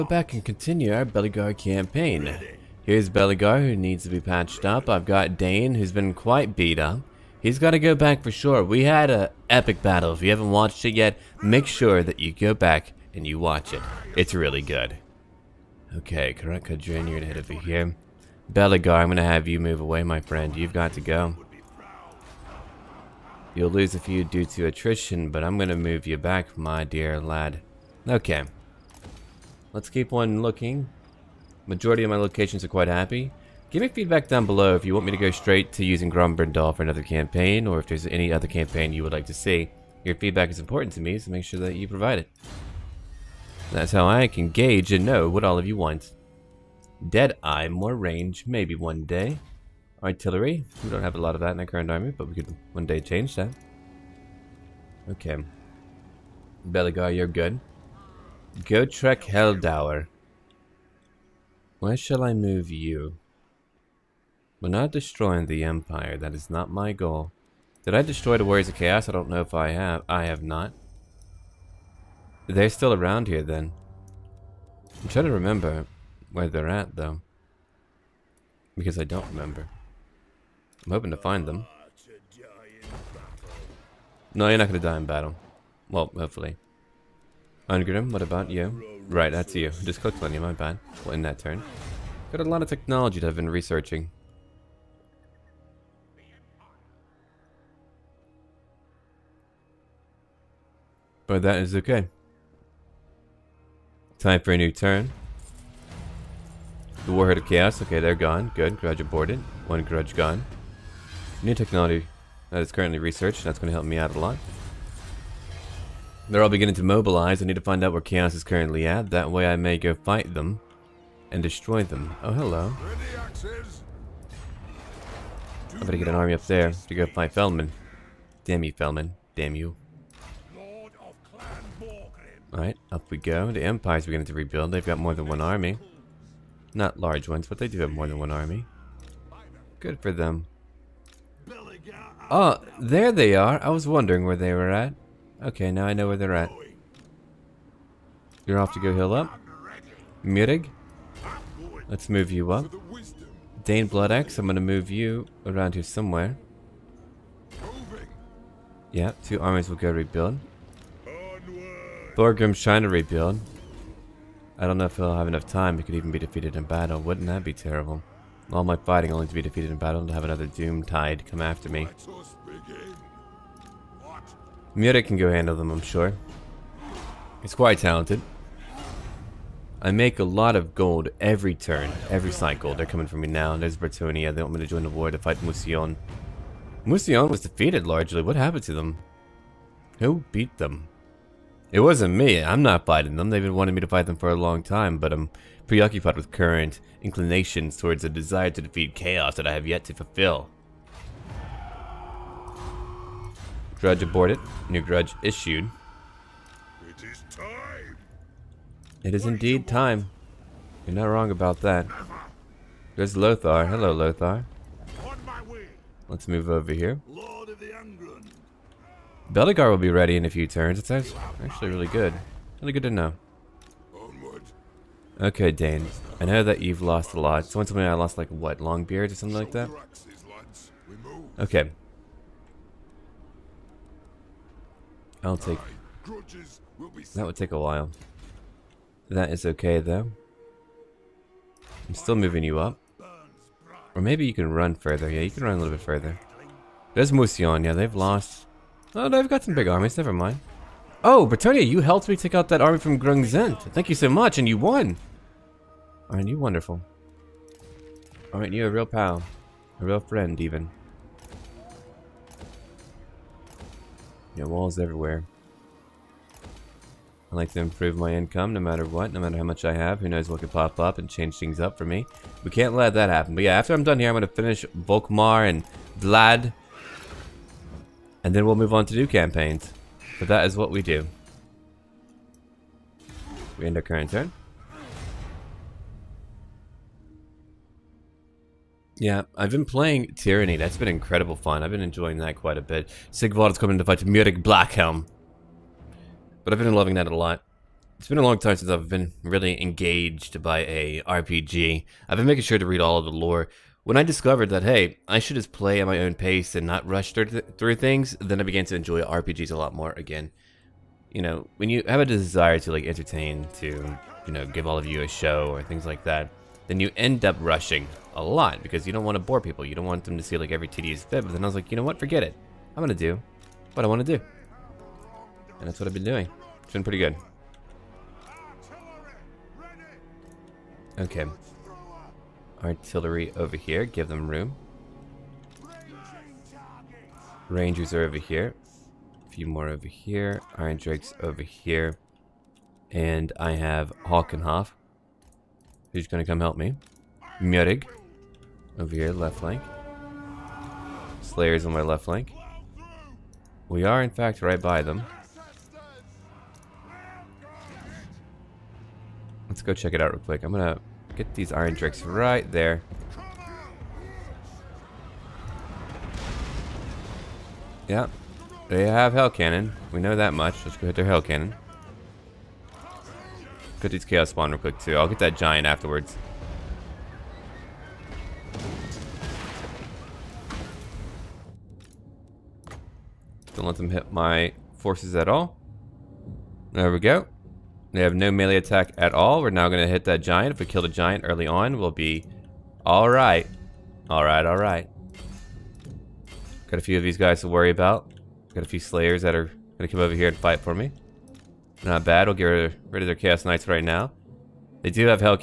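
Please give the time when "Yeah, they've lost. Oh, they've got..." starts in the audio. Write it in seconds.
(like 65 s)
247 s.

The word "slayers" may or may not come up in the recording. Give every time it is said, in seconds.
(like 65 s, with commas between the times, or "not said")
351 s, 398 s.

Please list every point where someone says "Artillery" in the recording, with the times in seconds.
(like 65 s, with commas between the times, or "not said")
50 s, 332 s.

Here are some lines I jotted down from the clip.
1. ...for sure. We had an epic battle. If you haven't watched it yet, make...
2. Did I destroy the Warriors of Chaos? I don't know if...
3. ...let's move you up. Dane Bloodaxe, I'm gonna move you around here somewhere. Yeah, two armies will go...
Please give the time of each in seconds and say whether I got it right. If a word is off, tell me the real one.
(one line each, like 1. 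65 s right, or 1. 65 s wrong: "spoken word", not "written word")
1. 8 s right
2. 67 s right
3. 151 s right.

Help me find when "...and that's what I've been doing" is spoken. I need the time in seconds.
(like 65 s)
325 s.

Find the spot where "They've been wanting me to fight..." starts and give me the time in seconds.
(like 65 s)
193 s.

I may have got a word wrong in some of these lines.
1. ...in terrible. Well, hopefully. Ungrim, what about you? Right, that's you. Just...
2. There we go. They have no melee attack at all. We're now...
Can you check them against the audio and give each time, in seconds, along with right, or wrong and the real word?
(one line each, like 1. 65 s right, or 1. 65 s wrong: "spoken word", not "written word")
1. 84 s wrong: "battle", not "terrible"
2. 386 s right.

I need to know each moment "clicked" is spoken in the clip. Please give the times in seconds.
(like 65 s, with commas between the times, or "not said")
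89 s.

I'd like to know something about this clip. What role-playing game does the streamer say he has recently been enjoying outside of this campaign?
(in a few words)
Tyranny.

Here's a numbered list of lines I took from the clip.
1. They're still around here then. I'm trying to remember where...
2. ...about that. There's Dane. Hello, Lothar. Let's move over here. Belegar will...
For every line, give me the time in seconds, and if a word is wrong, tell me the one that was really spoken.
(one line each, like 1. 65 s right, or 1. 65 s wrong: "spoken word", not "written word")
1. 72 s right
2. 211 s wrong: "Lothar", not "Dane".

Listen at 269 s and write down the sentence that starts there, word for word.
Who knows what could pop up and change things up for me.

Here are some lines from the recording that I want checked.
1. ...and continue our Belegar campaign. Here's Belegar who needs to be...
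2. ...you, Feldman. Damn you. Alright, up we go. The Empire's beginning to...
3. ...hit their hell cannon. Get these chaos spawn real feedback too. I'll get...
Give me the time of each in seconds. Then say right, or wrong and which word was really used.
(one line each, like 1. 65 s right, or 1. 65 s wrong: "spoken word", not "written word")
1. 0 s right
2. 128 s right
3. 370 s wrong: "quick", not "feedback".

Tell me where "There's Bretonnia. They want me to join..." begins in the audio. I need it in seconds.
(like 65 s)
183 s.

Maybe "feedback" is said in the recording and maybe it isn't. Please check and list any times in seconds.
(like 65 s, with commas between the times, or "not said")
33 s, 40 s.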